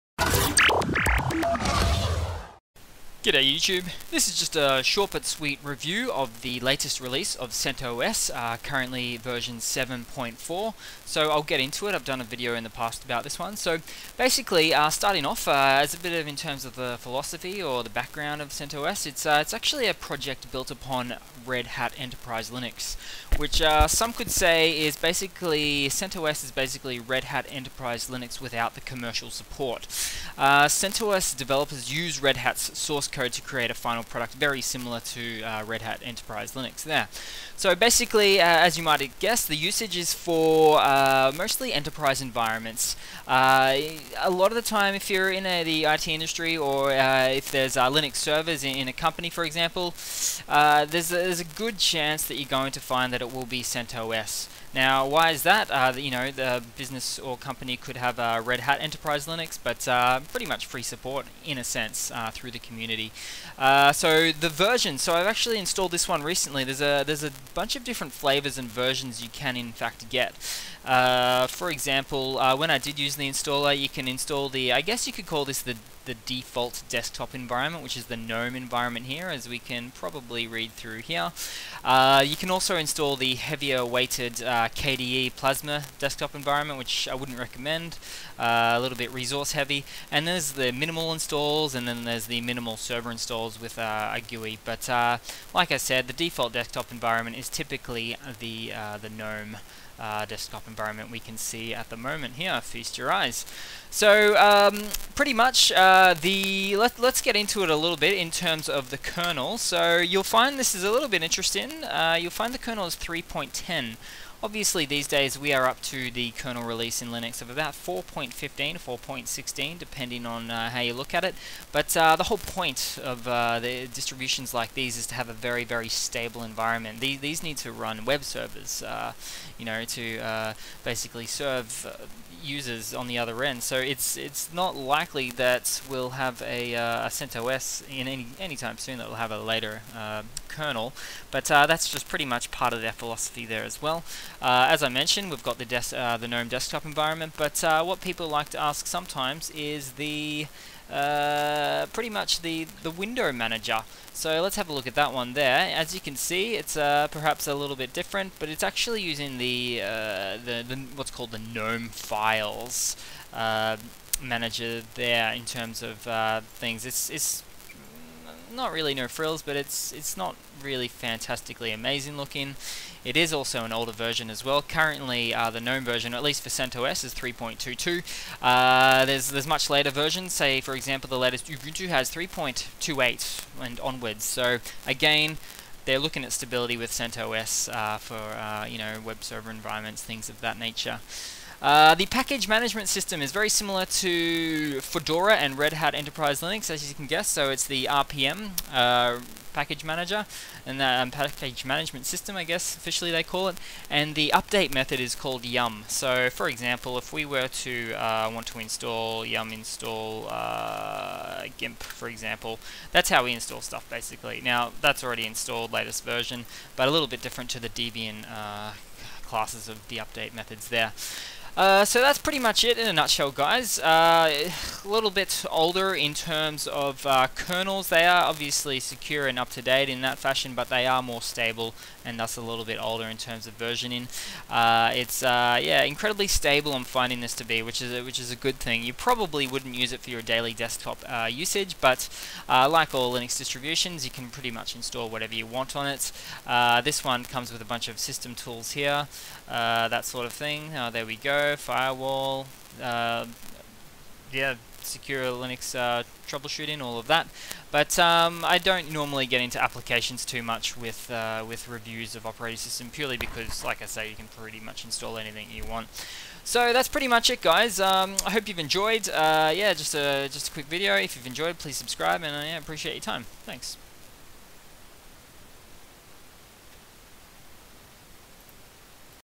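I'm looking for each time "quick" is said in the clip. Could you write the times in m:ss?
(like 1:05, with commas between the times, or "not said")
4:30.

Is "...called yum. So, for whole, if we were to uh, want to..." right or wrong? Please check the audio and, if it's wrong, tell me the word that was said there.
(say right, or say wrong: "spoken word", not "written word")
wrong: "example", not "whole".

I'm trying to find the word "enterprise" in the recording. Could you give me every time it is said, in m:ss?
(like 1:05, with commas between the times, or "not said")
0:21, 0:27, 0:36, 0:41, 0:58, 3:15.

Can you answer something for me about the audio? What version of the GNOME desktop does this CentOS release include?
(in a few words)
3.22.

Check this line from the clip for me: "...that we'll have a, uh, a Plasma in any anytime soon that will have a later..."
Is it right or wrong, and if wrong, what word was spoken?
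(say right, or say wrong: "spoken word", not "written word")
wrong: "CentOS", not "Plasma".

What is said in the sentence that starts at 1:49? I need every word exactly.
So you'll find this is a little bit interesting.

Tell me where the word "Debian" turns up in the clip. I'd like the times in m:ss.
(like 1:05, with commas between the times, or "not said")
3:37.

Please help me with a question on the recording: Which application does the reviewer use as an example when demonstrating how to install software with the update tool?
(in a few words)
GIMP.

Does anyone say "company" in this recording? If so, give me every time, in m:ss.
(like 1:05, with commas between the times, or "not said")
0:48, 0:57.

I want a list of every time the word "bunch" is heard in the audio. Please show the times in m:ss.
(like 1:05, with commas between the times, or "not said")
1:07, 4:07.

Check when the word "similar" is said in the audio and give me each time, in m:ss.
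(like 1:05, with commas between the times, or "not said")
0:34, 3:13.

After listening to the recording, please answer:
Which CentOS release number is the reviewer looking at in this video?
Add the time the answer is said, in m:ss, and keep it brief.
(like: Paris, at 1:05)
7.4, at 0:09.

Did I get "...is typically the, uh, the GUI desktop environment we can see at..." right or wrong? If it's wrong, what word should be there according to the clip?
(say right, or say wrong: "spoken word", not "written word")
wrong: "GNOME", not "GUI".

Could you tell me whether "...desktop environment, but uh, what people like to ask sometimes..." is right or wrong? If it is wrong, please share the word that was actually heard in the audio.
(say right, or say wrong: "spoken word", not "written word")
right.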